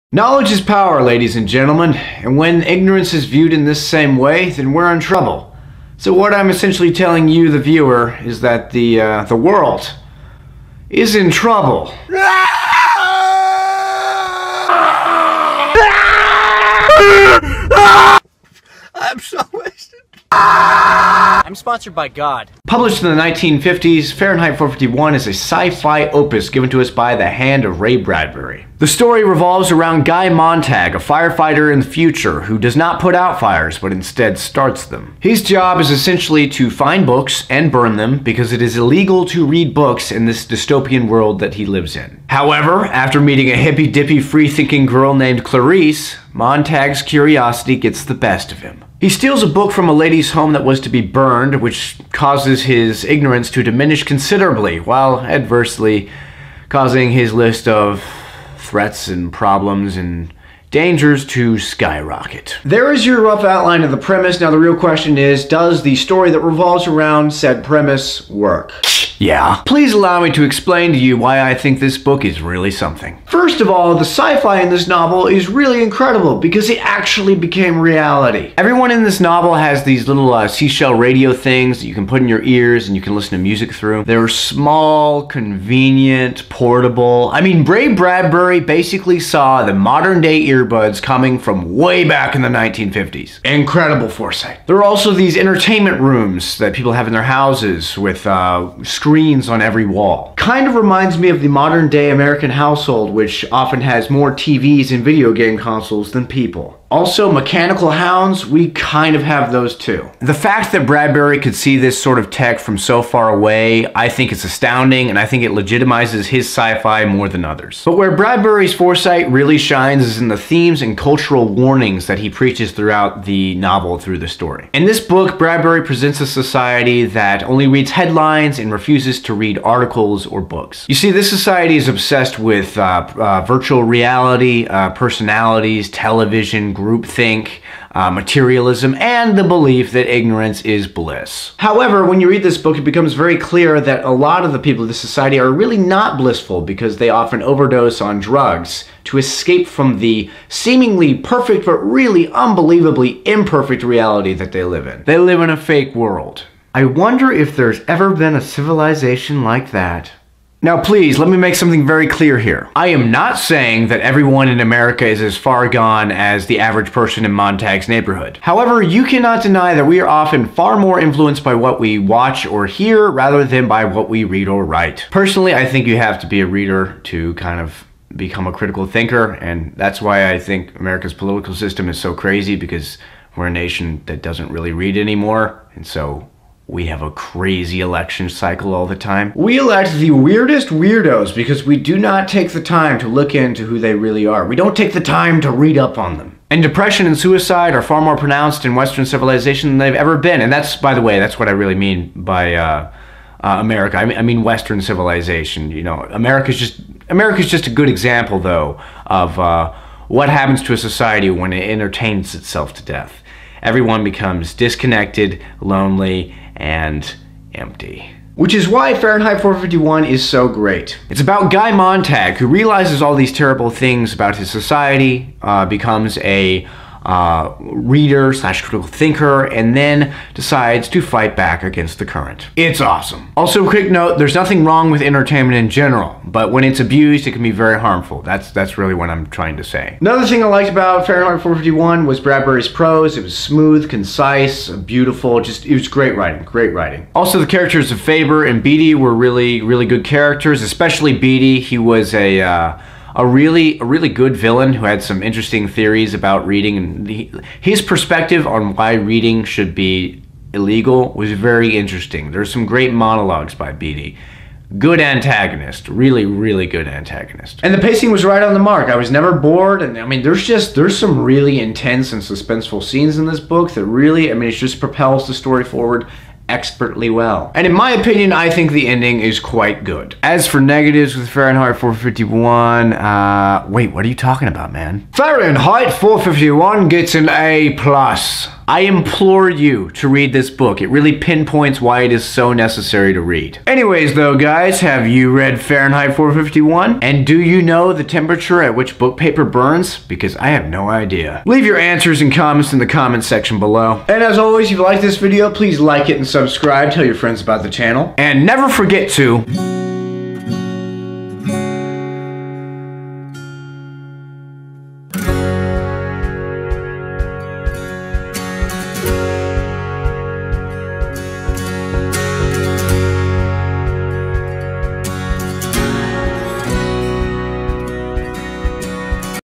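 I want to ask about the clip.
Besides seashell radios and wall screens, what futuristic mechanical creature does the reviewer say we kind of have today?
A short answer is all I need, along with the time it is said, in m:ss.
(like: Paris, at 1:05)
mechanical hounds, at 1:47.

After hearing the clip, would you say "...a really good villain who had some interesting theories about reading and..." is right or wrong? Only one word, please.
right.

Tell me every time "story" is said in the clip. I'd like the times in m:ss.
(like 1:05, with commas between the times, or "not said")
0:28, 1:05, 2:04, 4:35.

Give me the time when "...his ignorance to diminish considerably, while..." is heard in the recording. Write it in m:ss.
0:52.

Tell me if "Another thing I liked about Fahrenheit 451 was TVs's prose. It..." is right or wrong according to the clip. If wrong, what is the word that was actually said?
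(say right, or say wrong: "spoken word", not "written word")
wrong: "Bradbury", not "TVs".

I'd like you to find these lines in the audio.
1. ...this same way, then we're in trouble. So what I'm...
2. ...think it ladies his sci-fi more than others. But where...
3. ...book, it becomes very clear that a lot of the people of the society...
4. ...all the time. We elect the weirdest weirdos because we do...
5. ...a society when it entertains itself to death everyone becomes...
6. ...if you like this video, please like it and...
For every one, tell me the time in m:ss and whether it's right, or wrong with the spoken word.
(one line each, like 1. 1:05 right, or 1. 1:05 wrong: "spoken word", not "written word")
1. 0:03 right
2. 1:55 wrong: "legitimizes", not "ladies"
3. 2:22 right
4. 3:08 right
5. 3:30 right
6. 5:04 right.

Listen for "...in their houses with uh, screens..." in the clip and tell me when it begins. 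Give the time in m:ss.
1:37.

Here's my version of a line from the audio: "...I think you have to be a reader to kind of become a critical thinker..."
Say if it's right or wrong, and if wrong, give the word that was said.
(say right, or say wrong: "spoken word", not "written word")
right.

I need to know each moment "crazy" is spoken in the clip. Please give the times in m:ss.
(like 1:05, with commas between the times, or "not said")
3:02, 3:07.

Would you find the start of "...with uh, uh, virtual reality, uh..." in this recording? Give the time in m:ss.
2:12.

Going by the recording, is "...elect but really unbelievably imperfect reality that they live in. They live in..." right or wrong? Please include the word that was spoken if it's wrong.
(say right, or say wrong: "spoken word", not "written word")
wrong: "perfect", not "elect".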